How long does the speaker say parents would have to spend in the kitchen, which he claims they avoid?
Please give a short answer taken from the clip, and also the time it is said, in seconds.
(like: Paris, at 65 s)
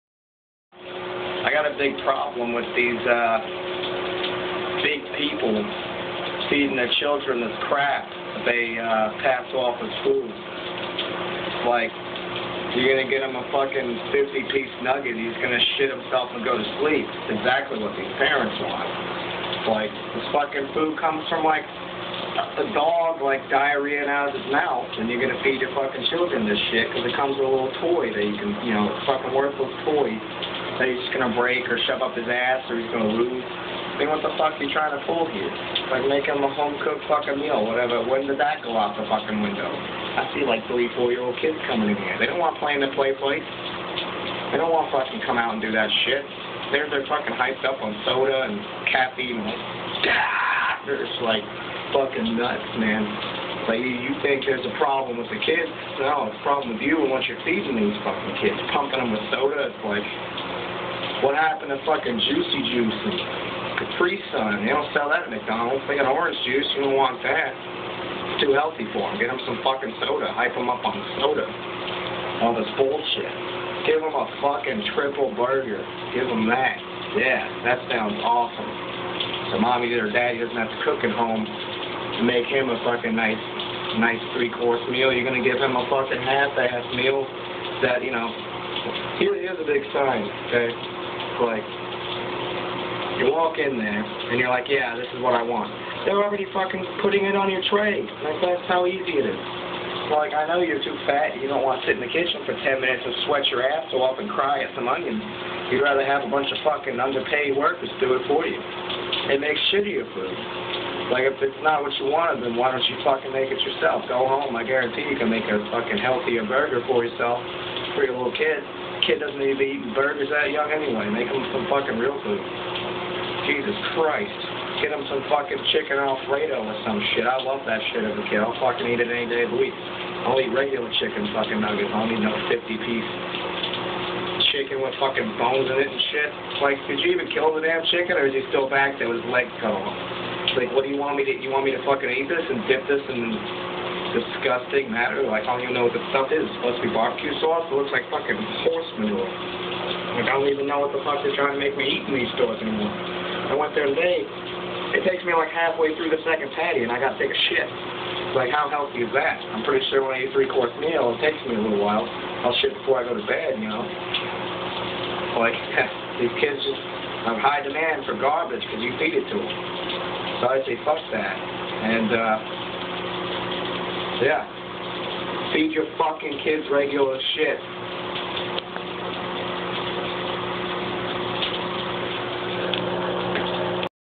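10 minutes, at 102 s.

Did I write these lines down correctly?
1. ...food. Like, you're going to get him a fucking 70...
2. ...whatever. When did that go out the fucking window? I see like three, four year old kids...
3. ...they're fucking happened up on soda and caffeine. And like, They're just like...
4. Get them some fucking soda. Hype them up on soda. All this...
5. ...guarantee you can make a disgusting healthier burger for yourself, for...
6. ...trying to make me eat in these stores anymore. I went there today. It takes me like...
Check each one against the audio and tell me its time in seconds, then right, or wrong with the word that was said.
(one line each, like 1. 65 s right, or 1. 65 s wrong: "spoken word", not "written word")
1. 10 s wrong: "50", not "70"
2. 37 s right
3. 46 s wrong: "hyped", not "happened"
4. 69 s right
5. 114 s wrong: "fucking", not "disgusting"
6. 151 s right.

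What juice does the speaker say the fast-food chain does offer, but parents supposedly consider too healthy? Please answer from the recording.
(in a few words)
Orange juice.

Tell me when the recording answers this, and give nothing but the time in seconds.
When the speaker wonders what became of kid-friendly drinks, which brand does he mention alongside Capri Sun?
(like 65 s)
62 s.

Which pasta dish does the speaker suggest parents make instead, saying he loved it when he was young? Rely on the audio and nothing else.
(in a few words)
Chicken Alfredo.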